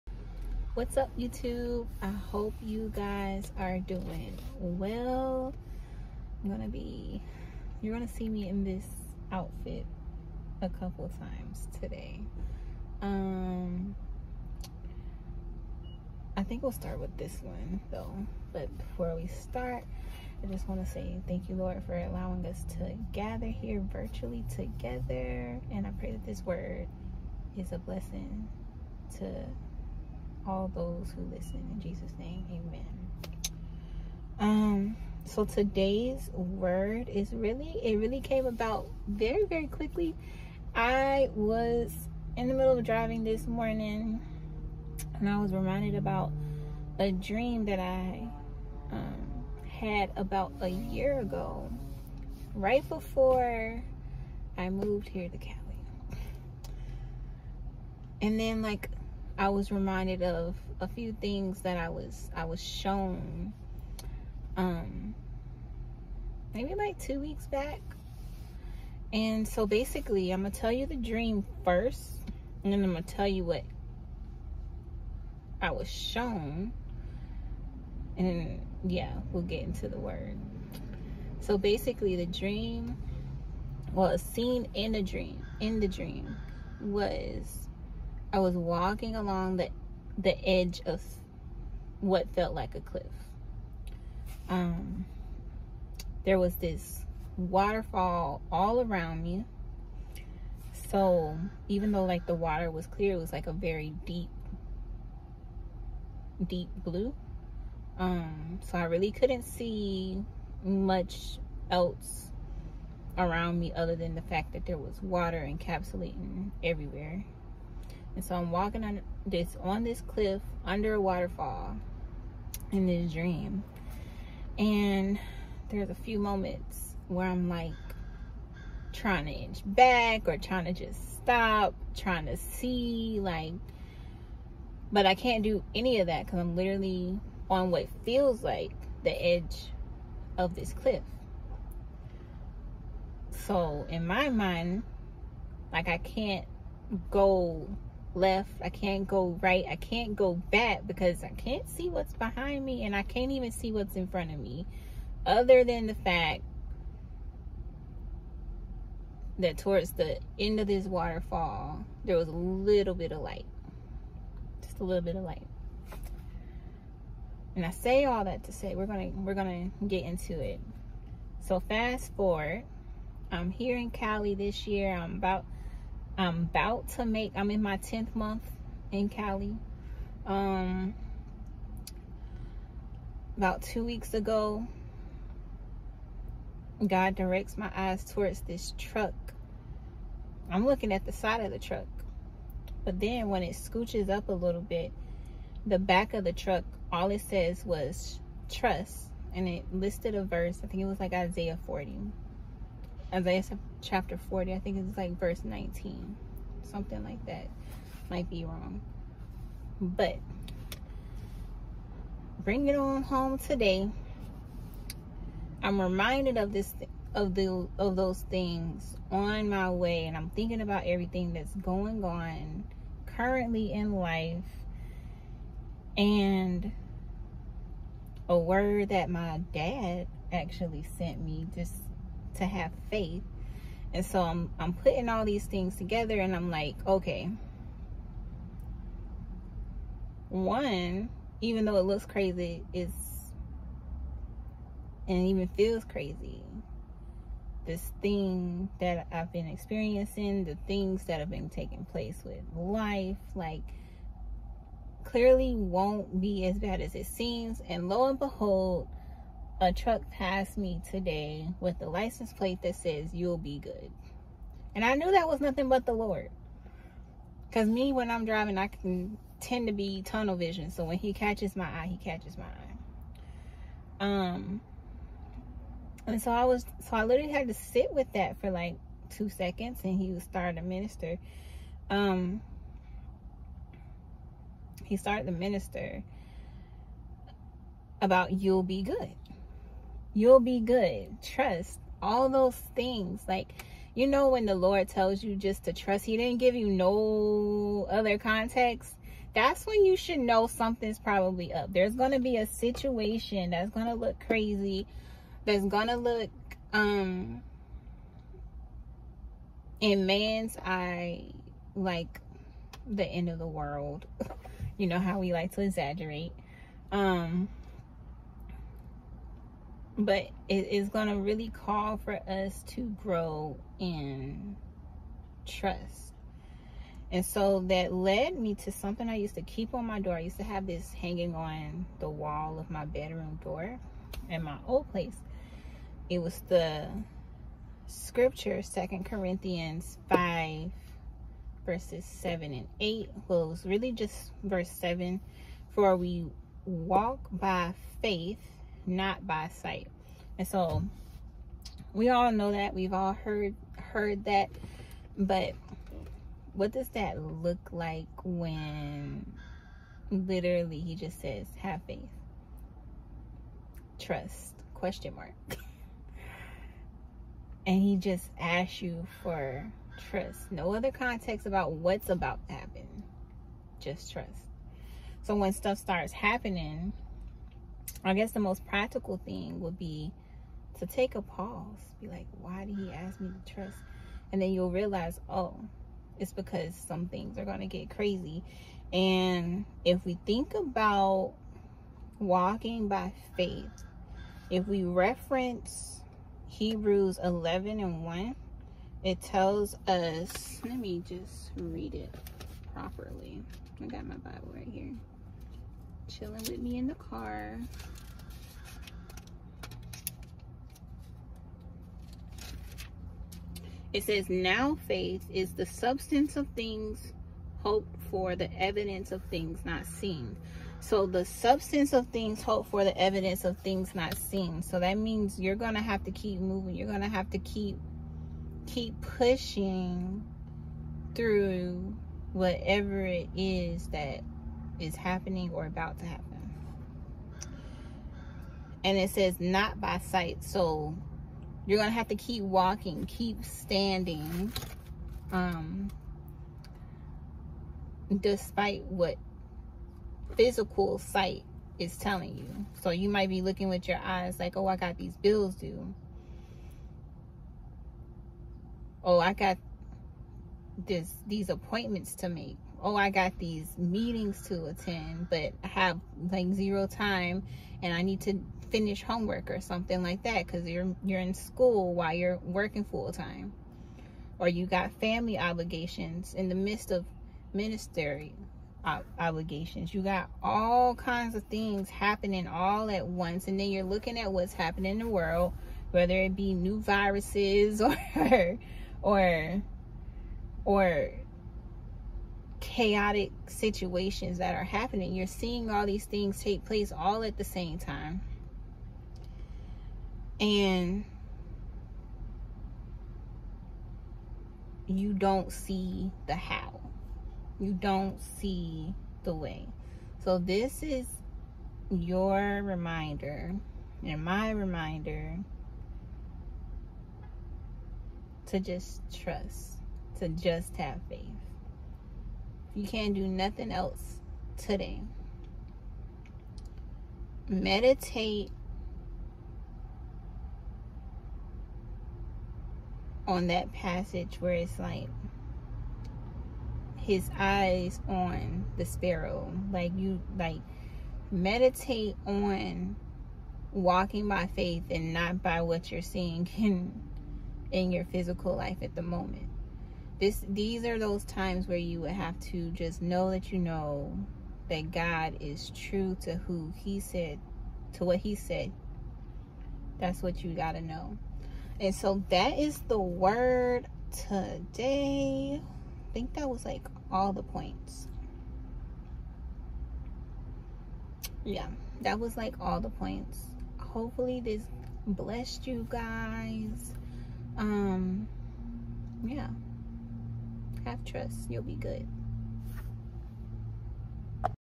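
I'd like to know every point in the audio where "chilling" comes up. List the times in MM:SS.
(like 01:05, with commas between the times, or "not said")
06:46.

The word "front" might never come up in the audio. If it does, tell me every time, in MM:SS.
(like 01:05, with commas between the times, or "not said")
02:34.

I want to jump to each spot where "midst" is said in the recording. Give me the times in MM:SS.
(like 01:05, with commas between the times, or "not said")
07:56.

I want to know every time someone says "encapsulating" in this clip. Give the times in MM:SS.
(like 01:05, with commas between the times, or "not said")
01:55.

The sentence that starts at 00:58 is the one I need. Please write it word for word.
And then, like, I was reminded of a few things that I was I was shown um maybe like 2 weeks back.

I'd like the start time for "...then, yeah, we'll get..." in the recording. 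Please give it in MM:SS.
01:18.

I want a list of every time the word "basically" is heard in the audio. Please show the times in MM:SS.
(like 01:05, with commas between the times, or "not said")
01:09, 01:21.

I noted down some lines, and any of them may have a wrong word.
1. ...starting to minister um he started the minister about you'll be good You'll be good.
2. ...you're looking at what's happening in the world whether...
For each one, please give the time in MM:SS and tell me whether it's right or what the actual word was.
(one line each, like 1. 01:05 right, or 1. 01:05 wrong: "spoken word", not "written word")
1. 04:40 right
2. 08:03 right.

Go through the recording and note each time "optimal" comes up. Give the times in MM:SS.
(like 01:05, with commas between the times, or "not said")
not said.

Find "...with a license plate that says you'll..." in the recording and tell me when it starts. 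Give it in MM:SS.
04:21.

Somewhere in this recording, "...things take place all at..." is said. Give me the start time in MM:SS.
08:16.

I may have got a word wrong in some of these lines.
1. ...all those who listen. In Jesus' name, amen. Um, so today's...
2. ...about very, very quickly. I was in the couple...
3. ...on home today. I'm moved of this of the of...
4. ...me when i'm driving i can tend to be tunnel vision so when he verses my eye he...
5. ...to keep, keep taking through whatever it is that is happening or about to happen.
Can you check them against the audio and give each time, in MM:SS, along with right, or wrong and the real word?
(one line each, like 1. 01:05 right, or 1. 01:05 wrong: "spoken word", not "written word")
1. 00:30 right
2. 00:38 wrong: "middle", not "couple"
3. 03:32 wrong: "reminded", not "moved"
4. 04:27 wrong: "catches", not "verses"
5. 07:07 wrong: "pushing", not "taking".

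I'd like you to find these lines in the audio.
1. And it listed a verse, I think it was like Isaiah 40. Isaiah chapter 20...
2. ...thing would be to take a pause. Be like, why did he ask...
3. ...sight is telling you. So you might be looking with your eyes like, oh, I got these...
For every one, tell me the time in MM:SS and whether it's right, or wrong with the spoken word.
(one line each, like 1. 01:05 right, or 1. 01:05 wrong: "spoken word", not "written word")
1. 03:19 wrong: "40", not "20"
2. 06:19 right
3. 07:30 right.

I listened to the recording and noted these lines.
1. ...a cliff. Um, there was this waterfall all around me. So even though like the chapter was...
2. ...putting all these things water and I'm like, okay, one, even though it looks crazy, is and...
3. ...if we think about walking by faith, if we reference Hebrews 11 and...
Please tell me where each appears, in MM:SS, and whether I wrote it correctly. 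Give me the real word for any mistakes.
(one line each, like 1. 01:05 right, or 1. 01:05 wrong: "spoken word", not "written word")
1. 01:32 wrong: "water", not "chapter"
2. 03:54 wrong: "together", not "water"
3. 06:29 right.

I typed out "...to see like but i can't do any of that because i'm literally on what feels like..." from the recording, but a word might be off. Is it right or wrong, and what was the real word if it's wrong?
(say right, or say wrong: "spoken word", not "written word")
right.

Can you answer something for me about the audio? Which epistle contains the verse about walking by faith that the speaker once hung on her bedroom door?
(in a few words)
Second Corinthians.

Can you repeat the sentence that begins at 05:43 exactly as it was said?
Well, it was really just verse 7.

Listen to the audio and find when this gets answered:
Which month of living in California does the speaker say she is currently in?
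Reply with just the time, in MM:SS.
02:57.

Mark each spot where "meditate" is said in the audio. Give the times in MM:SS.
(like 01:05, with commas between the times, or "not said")
08:47, 09:01.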